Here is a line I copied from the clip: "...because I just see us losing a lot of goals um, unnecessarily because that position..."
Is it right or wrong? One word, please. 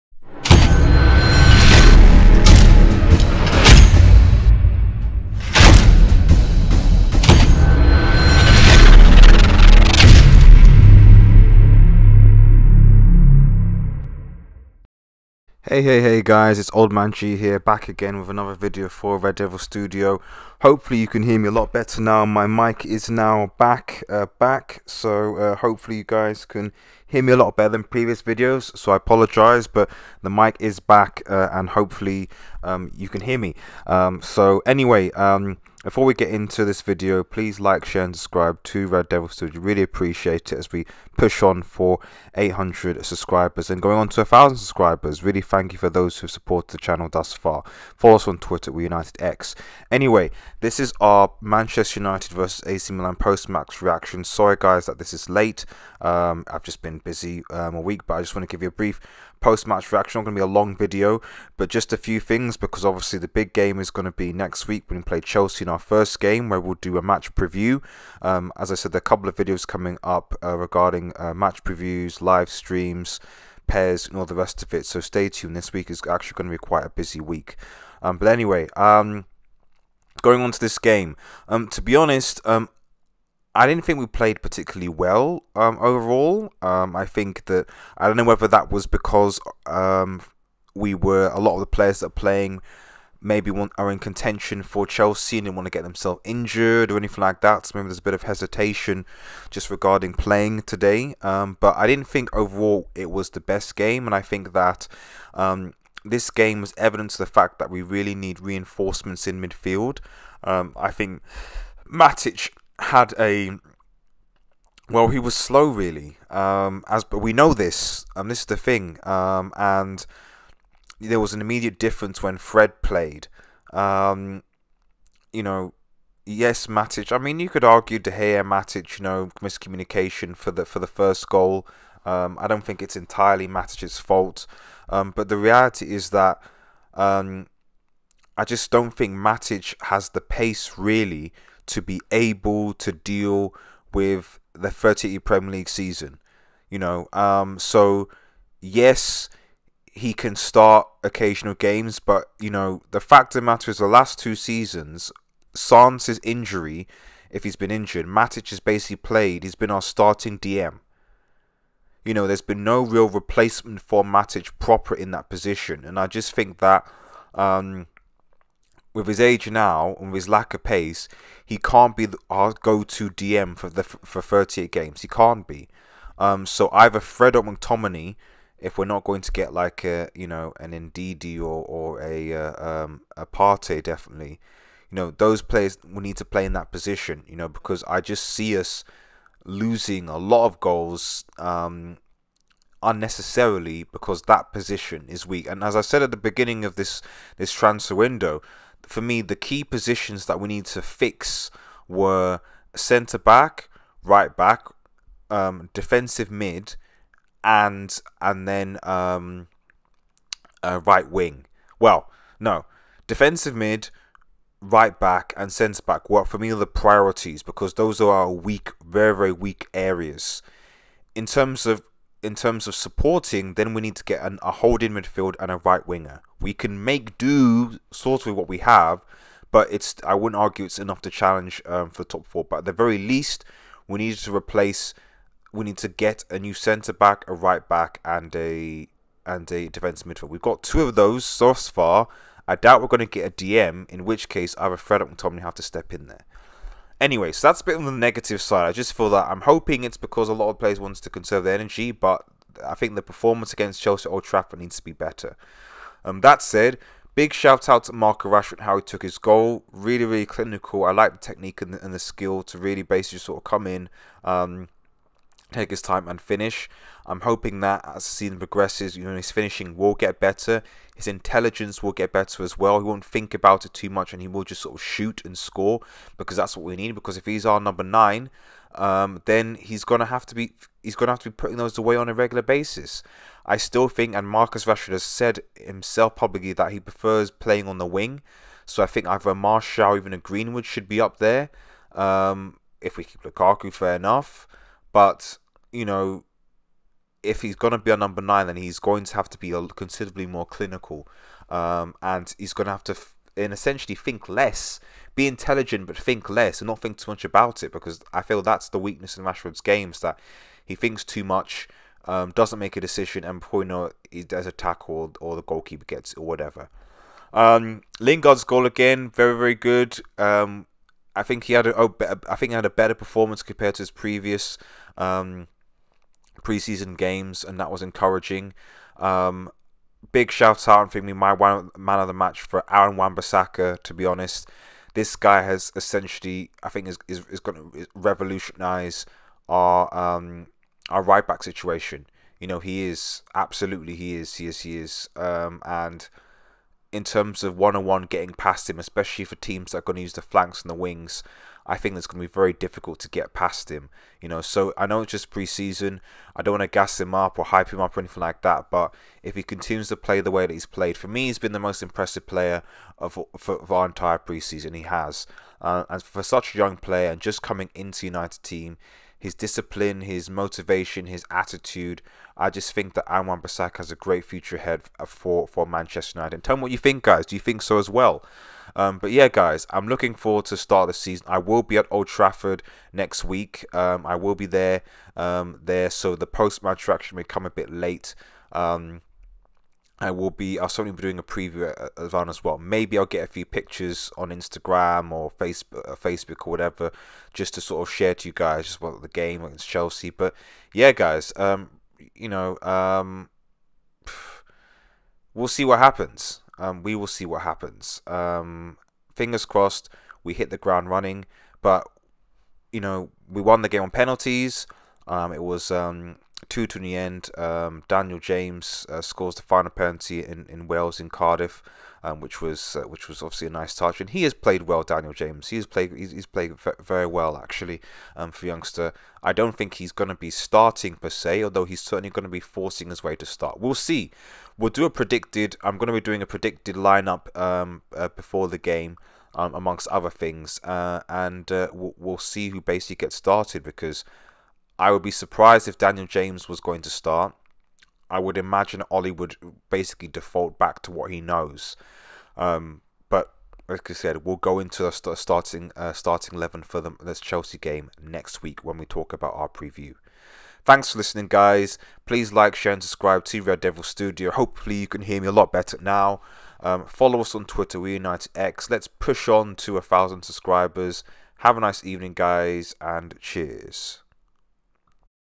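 right.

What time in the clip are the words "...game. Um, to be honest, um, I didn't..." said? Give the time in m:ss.
1:20.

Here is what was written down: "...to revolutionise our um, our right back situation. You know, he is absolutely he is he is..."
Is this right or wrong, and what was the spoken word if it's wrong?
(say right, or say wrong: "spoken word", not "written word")
right.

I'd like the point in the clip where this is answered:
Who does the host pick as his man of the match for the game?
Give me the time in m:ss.
5:32.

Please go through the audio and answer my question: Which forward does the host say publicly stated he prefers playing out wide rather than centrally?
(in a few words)
Marcus Rashford.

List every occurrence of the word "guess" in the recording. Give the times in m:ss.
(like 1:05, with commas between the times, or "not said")
not said.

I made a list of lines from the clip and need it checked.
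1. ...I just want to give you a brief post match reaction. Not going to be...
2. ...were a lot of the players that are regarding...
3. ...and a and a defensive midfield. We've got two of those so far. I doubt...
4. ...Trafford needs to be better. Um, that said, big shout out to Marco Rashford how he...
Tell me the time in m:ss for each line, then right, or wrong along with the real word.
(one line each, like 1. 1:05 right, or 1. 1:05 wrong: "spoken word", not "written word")
1. 0:58 right
2. 1:30 wrong: "playing", not "regarding"
3. 3:58 right
4. 4:14 right.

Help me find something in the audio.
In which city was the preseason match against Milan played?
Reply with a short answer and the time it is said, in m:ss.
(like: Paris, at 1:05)
Cardiff, at 7:01.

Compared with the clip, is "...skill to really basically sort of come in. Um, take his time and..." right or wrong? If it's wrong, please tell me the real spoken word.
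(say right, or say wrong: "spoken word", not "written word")
right.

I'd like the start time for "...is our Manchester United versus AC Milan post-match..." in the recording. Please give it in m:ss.
0:50.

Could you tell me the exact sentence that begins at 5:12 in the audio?
Um, doesn't make a decision and he does a tackle or, the goalkeeper gets or whatever.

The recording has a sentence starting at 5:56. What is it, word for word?
I don't want to gas him up or hype him up or anything like that.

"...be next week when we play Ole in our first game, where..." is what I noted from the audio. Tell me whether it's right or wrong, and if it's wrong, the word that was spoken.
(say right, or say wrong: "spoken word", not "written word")
wrong: "Chelsea", not "Ole".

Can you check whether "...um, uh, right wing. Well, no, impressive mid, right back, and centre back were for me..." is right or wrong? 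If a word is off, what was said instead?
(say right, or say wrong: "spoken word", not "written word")
wrong: "defensive", not "impressive".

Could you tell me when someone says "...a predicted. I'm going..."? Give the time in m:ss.
7:14.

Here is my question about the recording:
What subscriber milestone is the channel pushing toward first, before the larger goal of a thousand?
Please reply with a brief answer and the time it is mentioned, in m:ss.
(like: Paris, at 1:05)
800, at 0:42.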